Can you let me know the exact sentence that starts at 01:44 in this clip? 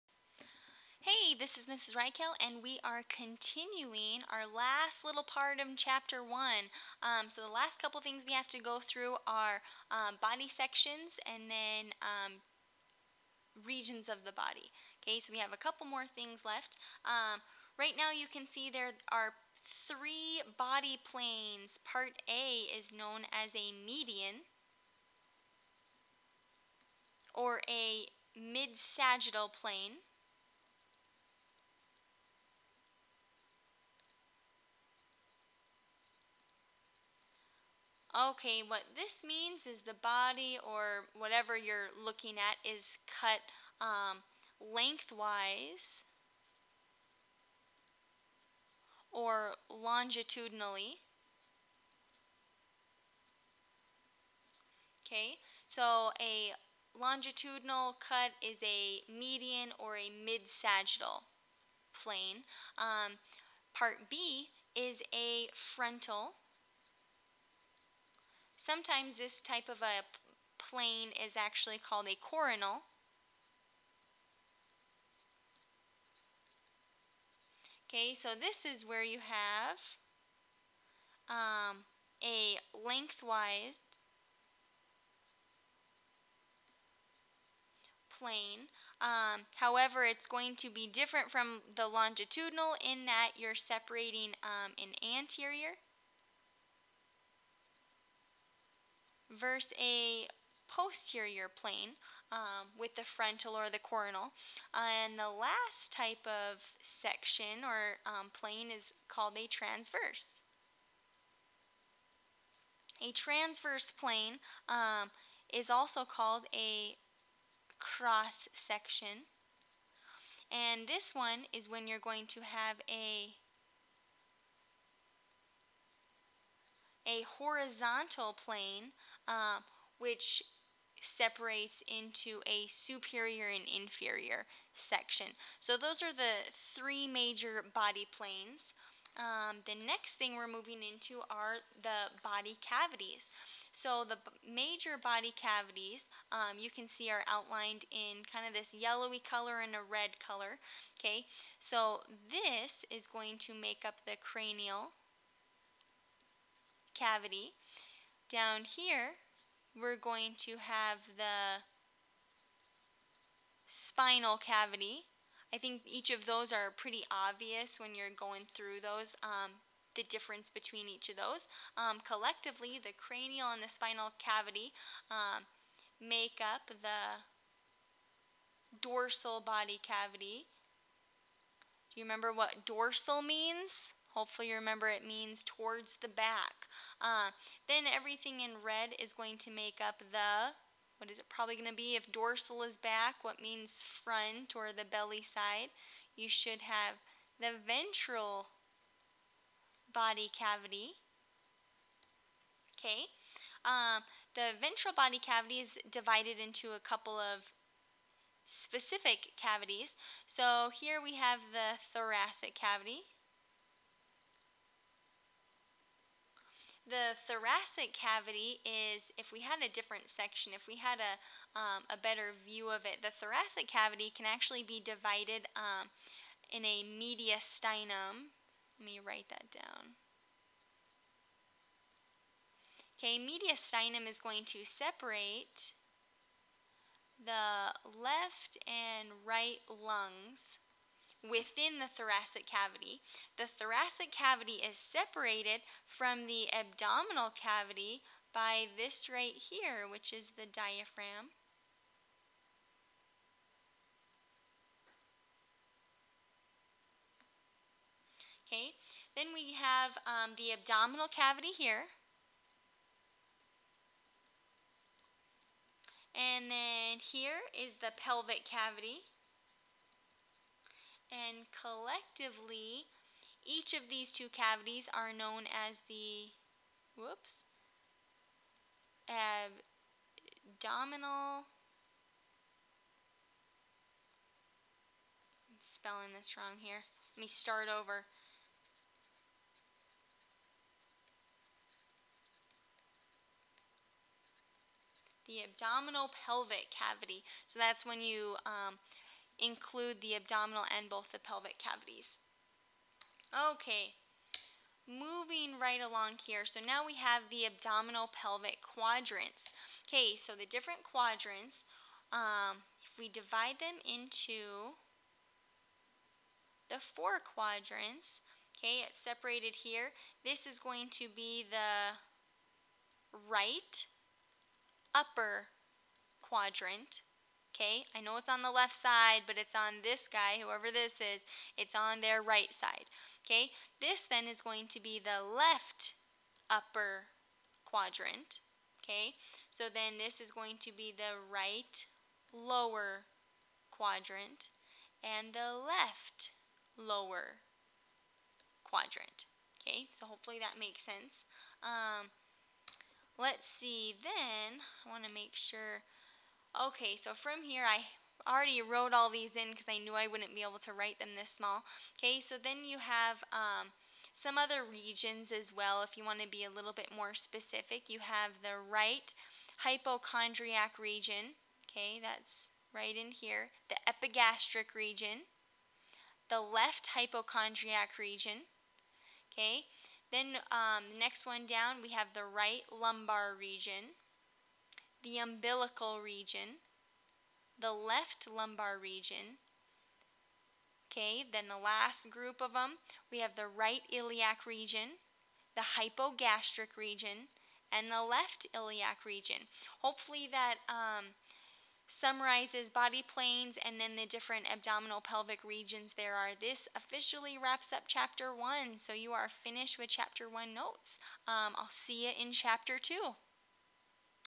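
And the last type of section or um, plane is called a transverse.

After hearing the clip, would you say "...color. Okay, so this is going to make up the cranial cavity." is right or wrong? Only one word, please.
right.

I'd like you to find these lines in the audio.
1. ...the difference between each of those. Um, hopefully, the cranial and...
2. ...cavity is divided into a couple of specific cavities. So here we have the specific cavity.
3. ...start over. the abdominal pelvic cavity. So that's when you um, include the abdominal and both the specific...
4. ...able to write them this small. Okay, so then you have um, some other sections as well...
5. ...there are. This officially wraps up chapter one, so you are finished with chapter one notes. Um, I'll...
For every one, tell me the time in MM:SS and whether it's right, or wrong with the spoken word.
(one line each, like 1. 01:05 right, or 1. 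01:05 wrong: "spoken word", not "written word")
1. 02:49 wrong: "collectively", not "hopefully"
2. 03:25 wrong: "thoracic", not "specific"
3. 04:47 wrong: "pelvic", not "specific"
4. 06:00 wrong: "regions", not "sections"
5. 06:45 right.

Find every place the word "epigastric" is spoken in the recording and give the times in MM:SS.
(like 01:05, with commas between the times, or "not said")
06:13.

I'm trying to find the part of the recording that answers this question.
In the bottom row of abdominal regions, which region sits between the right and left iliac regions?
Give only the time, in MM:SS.
06:35.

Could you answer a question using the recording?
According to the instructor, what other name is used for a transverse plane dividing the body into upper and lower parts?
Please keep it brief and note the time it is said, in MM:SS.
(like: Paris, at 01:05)
cross section, at 01:57.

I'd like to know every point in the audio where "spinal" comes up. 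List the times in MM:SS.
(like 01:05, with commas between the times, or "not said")
02:43, 02:53.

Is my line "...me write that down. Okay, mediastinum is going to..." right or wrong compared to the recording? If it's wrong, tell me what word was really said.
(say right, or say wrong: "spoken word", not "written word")
right.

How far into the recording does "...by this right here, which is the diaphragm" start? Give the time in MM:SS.
04:08.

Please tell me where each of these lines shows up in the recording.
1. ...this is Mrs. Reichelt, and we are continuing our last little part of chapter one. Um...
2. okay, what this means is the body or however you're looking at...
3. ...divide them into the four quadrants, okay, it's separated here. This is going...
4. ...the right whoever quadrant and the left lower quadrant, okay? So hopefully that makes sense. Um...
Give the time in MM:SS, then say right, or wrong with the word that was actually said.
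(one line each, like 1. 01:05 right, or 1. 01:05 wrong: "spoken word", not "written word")
1. 00:01 right
2. 00:38 wrong: "whatever", not "however"
3. 05:13 right
4. 05:40 wrong: "lower", not "whoever".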